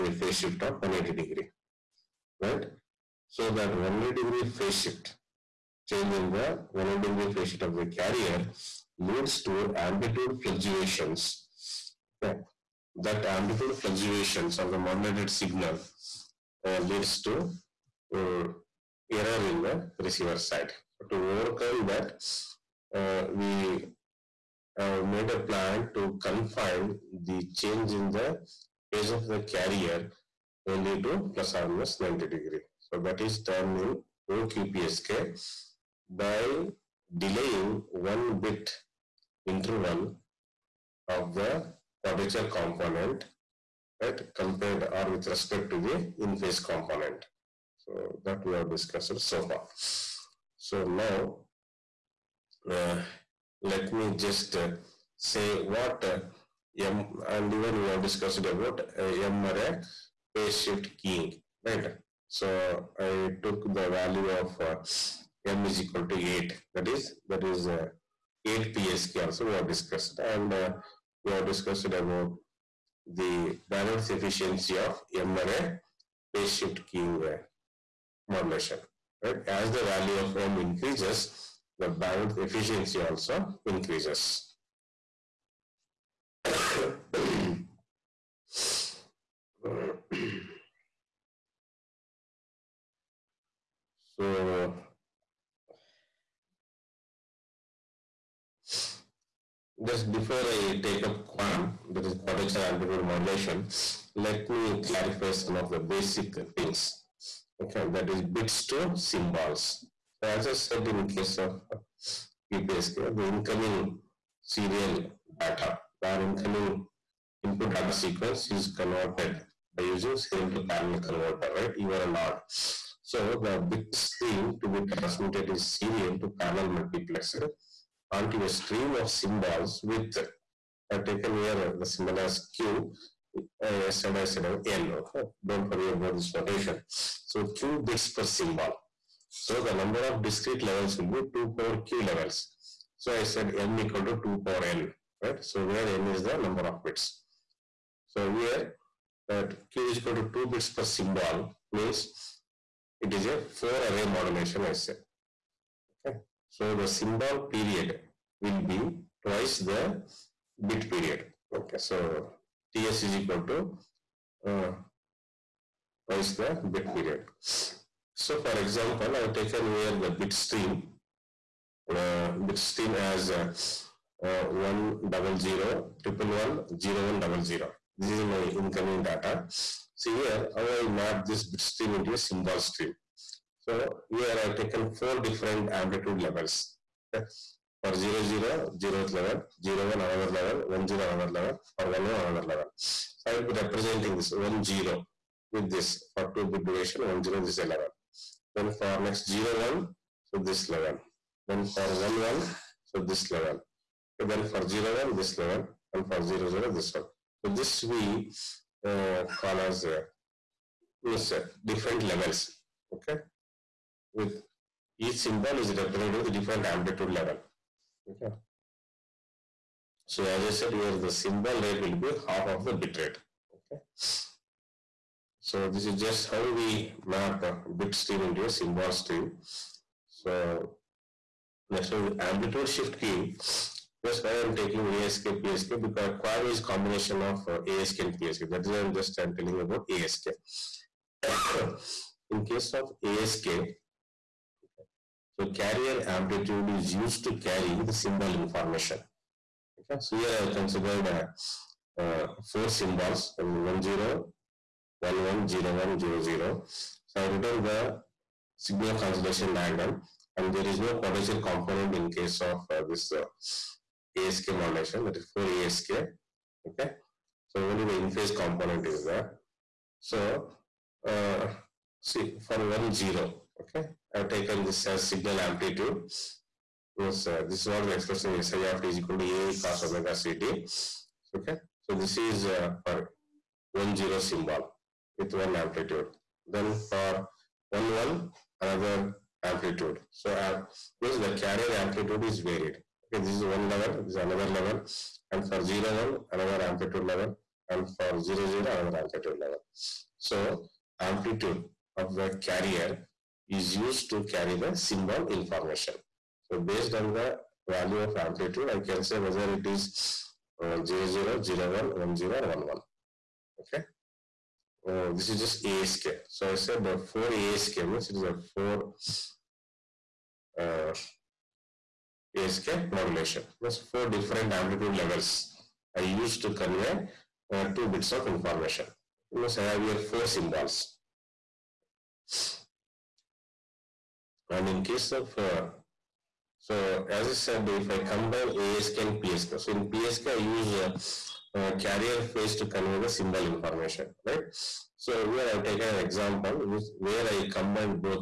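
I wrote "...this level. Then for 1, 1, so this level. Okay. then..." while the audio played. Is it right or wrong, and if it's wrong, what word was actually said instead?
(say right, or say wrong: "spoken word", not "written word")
right.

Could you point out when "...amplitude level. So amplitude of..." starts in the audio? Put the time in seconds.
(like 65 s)
299 s.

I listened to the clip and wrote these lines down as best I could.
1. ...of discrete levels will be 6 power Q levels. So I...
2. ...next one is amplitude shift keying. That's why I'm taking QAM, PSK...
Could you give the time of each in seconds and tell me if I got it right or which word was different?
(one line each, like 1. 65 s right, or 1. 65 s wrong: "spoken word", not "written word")
1. 140 s wrong: "2", not "6"
2. 231 s wrong: "ASK", not "QAM".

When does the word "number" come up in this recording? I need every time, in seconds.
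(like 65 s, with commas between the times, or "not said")
139 s, 146 s.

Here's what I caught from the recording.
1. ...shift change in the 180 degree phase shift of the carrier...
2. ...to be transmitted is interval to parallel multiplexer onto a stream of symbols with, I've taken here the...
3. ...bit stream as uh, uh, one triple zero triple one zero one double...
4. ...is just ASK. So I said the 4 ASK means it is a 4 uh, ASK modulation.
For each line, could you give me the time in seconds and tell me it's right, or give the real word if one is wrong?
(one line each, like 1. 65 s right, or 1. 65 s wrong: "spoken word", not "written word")
1. 4 s right
2. 124 s wrong: "serial", not "interval"
3. 172 s wrong: "double", not "triple"
4. 315 s right.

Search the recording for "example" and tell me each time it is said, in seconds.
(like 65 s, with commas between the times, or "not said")
168 s, 345 s.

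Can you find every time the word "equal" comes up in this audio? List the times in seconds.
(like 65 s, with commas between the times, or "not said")
65 s, 143 s, 149 s, 163 s, 278 s.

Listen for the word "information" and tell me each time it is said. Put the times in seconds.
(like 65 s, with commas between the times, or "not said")
248 s, 305 s, 328 s, 343 s.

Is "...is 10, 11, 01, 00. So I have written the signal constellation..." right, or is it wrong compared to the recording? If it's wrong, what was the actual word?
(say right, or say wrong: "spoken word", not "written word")
right.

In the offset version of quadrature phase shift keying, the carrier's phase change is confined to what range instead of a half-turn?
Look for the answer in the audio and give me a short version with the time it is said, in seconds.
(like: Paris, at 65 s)
plus or minus 90 degree, at 31 s.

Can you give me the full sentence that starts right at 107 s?
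Okay, that is bits to symbols.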